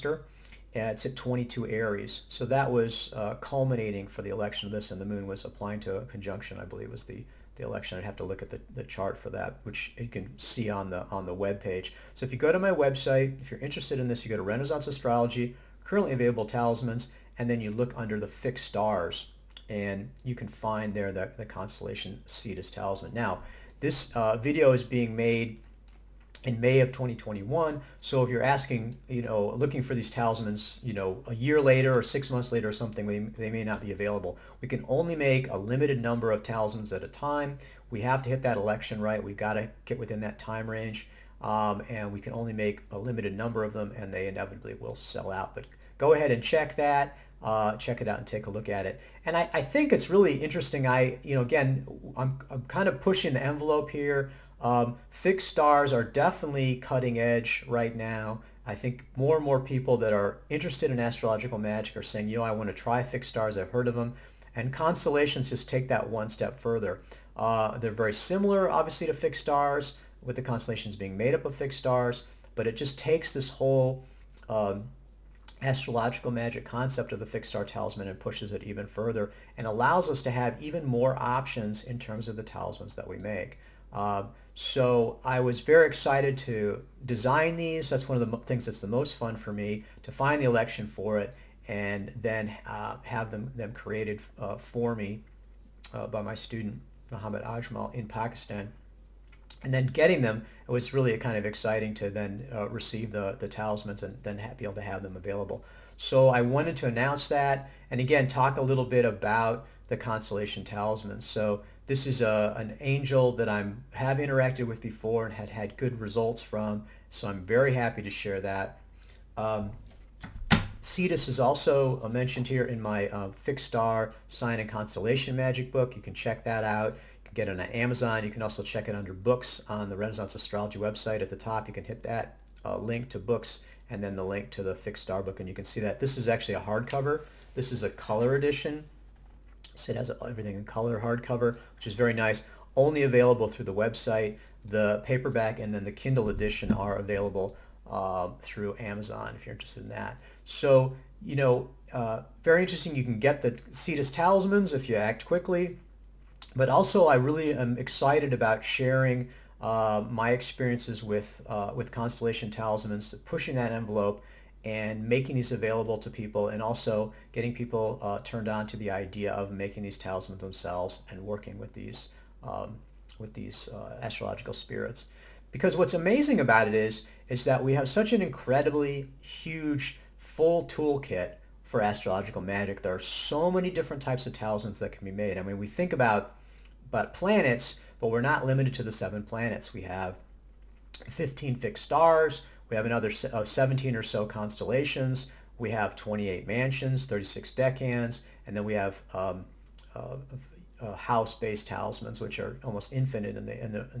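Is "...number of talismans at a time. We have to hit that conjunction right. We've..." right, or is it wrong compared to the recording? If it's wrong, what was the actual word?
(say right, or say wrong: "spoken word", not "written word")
wrong: "election", not "conjunction".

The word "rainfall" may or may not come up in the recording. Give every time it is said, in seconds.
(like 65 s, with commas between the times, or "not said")
not said.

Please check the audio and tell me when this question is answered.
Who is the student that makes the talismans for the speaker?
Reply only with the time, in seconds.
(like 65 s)
97 s.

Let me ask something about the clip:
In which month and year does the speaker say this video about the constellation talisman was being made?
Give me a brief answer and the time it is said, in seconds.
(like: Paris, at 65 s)
May 2021, at 26 s.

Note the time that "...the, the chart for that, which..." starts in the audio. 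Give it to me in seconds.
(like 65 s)
8 s.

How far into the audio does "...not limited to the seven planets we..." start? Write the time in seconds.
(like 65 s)
188 s.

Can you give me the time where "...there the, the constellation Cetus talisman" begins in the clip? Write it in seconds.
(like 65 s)
20 s.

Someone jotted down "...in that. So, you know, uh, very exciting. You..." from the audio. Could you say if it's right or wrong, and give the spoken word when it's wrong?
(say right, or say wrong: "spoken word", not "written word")
wrong: "interesting", not "exciting".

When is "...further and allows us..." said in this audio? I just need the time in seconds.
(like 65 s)
78 s.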